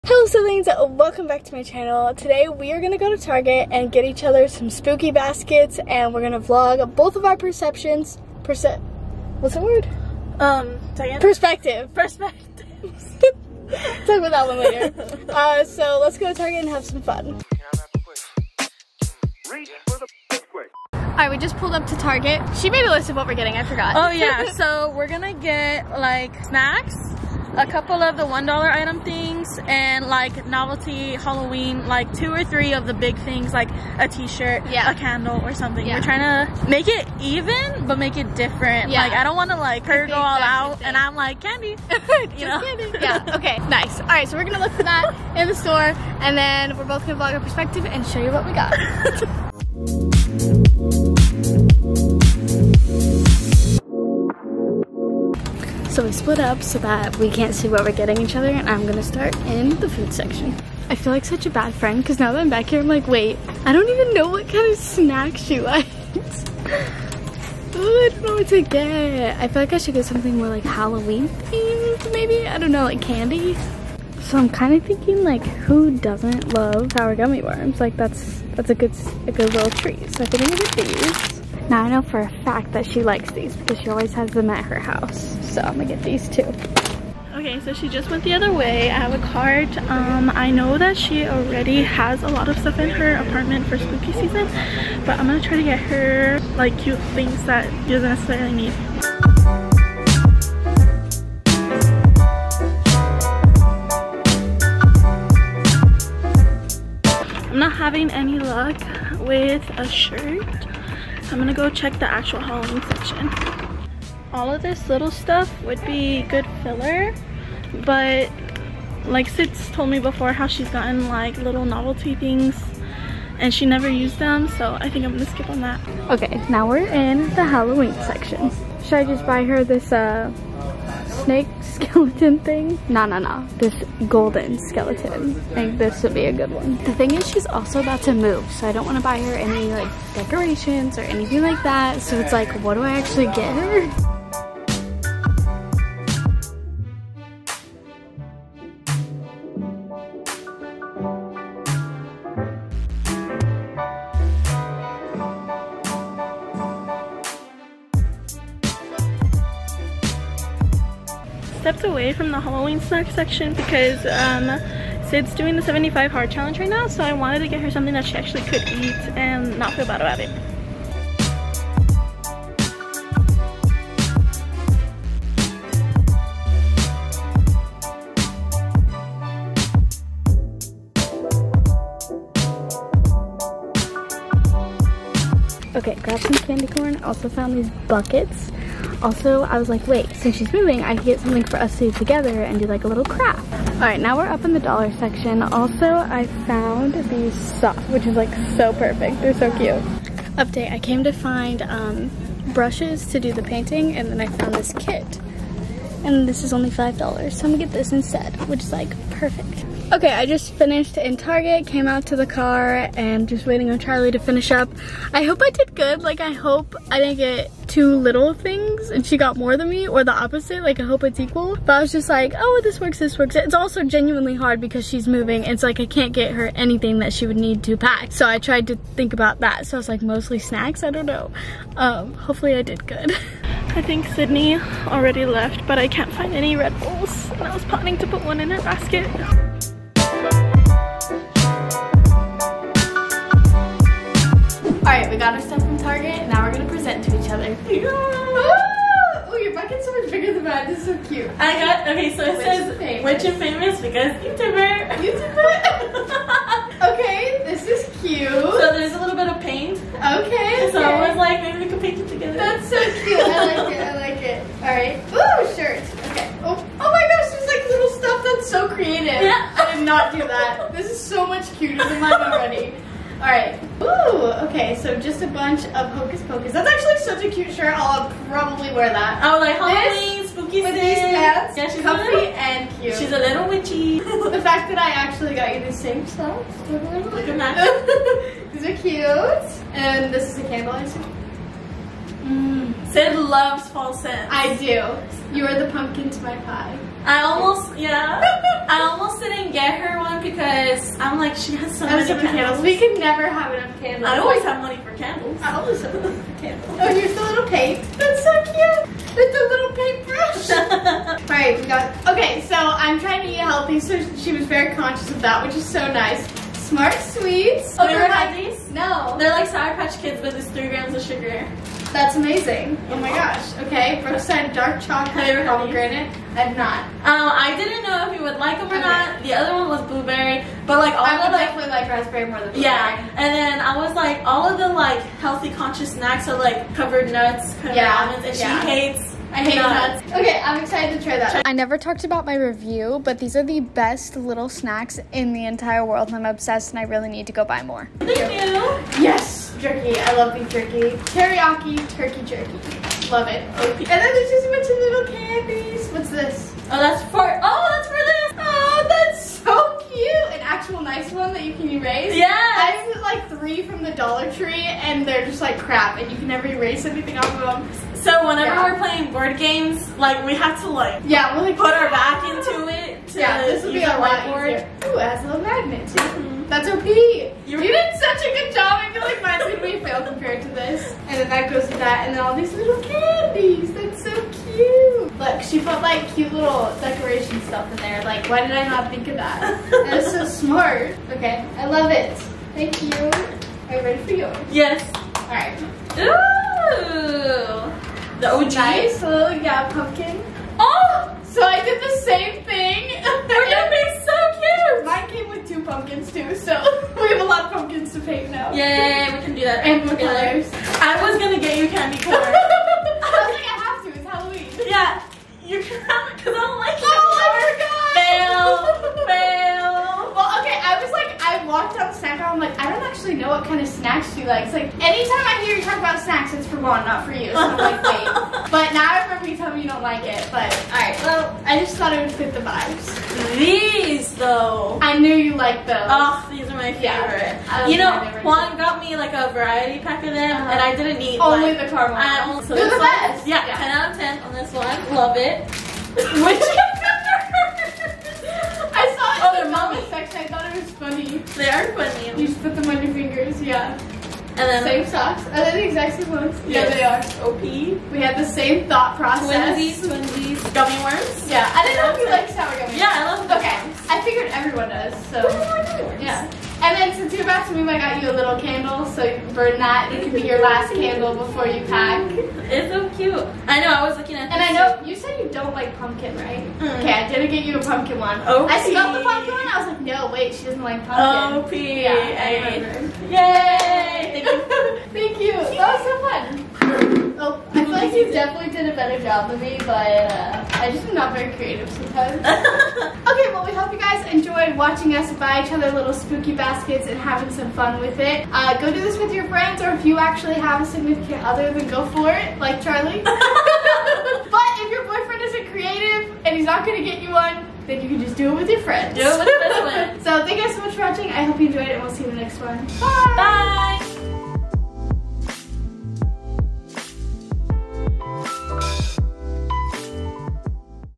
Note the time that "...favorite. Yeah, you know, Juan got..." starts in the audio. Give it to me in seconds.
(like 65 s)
436 s.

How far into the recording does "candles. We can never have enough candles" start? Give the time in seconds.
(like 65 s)
302 s.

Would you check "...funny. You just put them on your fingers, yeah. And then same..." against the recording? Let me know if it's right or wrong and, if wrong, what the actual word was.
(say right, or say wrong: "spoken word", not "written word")
right.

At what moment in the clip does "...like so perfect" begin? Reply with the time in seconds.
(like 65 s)
198 s.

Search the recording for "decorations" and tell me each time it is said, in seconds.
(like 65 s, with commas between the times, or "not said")
140 s, 386 s.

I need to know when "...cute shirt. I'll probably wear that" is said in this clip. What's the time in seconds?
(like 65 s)
277 s.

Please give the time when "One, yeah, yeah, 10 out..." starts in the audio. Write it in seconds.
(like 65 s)
443 s.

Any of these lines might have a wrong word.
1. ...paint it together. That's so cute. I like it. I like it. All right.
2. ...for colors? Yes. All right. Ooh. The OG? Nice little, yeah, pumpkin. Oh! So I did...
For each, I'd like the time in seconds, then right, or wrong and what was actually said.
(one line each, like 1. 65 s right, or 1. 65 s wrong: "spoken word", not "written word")
1. 261 s right
2. 394 s wrong: "yours", not "colors".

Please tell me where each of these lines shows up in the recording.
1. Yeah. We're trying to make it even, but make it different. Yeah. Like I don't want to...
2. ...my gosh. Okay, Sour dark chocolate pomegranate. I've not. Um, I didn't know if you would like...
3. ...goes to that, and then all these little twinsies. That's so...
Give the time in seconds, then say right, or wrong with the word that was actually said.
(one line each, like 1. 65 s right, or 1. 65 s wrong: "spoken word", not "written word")
1. 35 s right
2. 322 s wrong: "Brookside", not "Sour"
3. 381 s wrong: "candies", not "twinsies".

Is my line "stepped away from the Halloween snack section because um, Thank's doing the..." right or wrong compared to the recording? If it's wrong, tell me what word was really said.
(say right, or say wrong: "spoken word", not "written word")
wrong: "Syd", not "Thank".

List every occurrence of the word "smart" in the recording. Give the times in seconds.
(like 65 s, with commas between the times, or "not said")
316 s, 390 s.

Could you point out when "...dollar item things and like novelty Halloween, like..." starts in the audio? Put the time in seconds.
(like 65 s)
28 s.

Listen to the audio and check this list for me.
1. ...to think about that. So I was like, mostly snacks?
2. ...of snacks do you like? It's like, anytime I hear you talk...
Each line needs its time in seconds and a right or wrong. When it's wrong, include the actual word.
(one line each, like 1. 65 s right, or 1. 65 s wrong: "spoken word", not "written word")
1. 228 s right
2. 423 s right.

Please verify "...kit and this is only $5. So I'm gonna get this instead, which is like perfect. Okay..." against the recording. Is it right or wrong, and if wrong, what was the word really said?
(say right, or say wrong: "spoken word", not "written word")
right.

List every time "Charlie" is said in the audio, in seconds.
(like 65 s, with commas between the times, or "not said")
213 s, 502 s.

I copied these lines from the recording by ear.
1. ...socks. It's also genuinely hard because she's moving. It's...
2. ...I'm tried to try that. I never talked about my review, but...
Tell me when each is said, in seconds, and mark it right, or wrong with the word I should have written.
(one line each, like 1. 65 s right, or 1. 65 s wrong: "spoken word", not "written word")
1. 223 s wrong: "works", not "socks"
2. 340 s wrong: "excited", not "tried".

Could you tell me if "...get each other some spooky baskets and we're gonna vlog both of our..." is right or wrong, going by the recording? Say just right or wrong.
right.